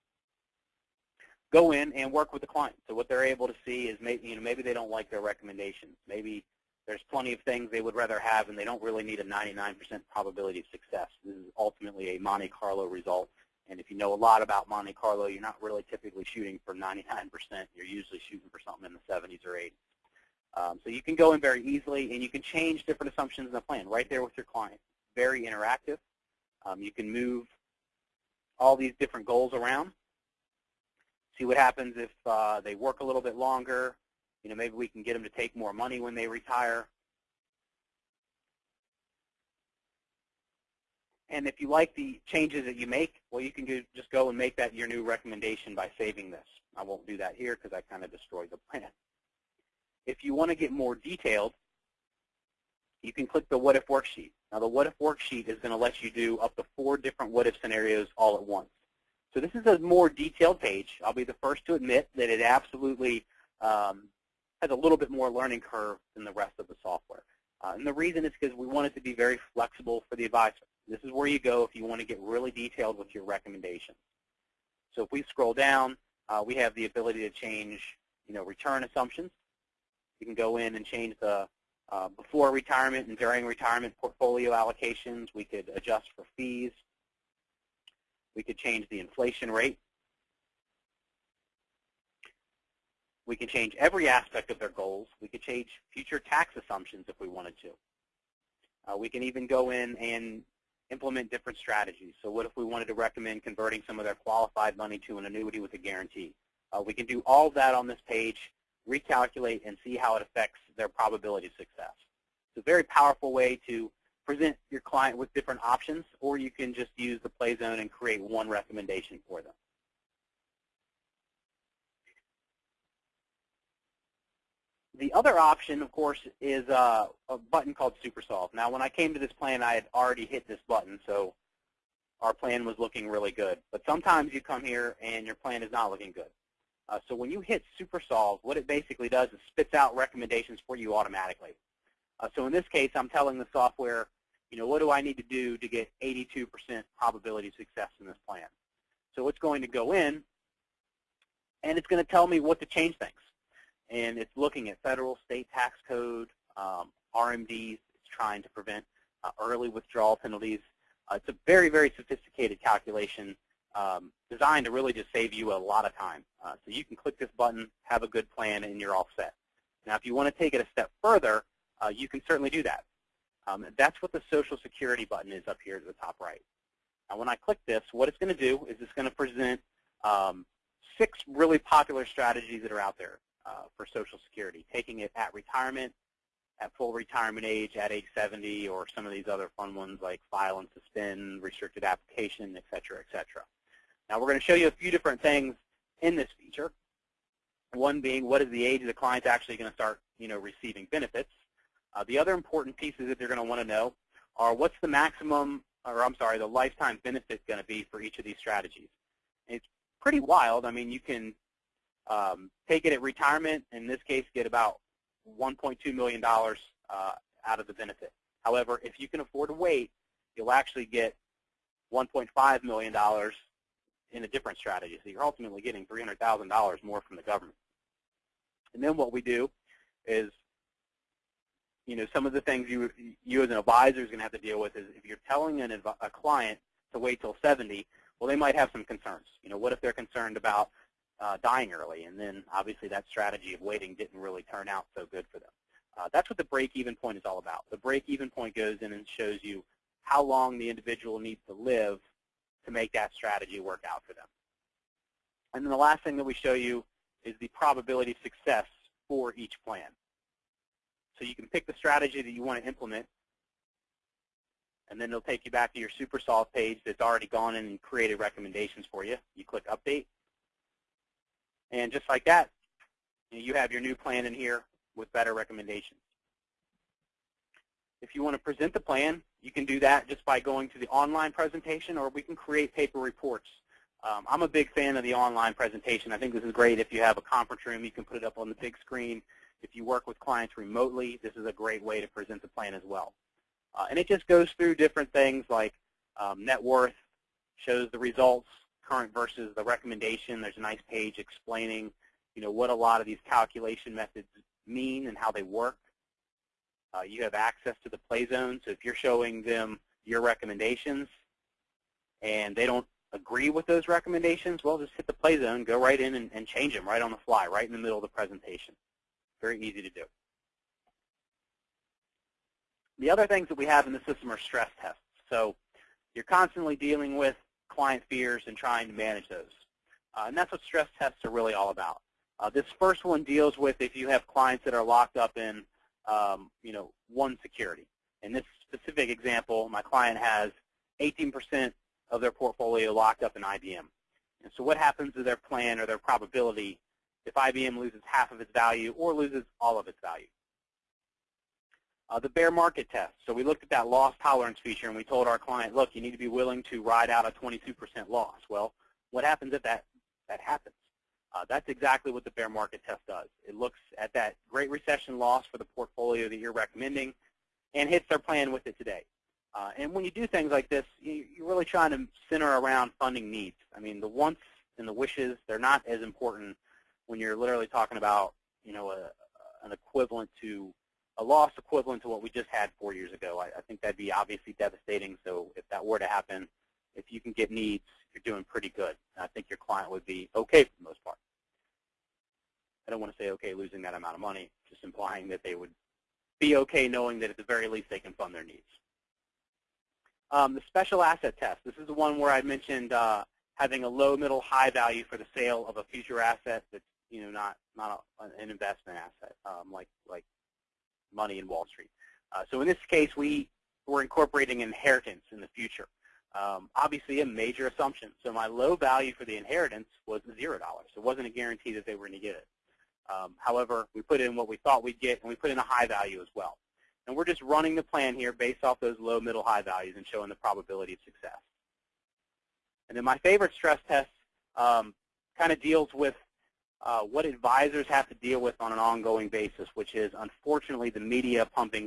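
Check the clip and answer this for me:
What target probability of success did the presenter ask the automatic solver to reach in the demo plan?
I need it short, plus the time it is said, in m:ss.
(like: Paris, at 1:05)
82%, at 2:26.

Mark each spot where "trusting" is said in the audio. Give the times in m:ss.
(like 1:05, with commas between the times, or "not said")
not said.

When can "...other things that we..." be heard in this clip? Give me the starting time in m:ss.
5:23.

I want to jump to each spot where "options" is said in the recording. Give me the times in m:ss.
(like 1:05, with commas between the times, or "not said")
1:55, 2:05.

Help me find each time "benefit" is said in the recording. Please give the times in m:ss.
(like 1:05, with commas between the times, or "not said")
3:20, 3:27, 3:37.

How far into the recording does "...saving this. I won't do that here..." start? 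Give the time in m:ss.
0:45.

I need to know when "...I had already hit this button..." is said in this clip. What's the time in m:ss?
2:09.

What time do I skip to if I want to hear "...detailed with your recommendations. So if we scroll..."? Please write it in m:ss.
1:12.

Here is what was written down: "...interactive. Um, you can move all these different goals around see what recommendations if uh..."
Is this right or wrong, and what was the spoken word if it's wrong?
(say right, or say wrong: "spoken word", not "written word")
wrong: "happens", not "recommendations".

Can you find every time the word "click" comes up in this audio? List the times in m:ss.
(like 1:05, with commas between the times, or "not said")
0:53, 2:46, 2:57, 4:29.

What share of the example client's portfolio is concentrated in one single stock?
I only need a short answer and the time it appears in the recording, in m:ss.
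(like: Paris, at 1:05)
18%, at 5:41.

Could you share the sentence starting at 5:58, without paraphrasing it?
Well, what happens if that, that happens?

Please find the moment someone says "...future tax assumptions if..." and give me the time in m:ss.
1:35.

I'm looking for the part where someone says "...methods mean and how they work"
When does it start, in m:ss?
5:03.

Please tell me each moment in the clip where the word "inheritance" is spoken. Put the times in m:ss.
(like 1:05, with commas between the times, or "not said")
6:54, 6:59.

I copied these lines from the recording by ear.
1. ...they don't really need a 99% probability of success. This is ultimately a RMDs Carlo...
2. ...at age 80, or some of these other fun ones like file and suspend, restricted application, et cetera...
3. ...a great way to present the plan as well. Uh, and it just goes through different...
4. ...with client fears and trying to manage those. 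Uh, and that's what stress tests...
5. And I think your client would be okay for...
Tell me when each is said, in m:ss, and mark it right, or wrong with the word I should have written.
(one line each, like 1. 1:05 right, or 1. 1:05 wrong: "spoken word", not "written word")
1. 0:08 wrong: "Monte", not "RMDs"
2. 3:07 wrong: "70", not "80"
3. 4:51 right
4. 5:27 right
5. 6:29 right.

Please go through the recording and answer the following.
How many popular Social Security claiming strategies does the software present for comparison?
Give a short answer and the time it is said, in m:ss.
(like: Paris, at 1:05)
6, at 3:00.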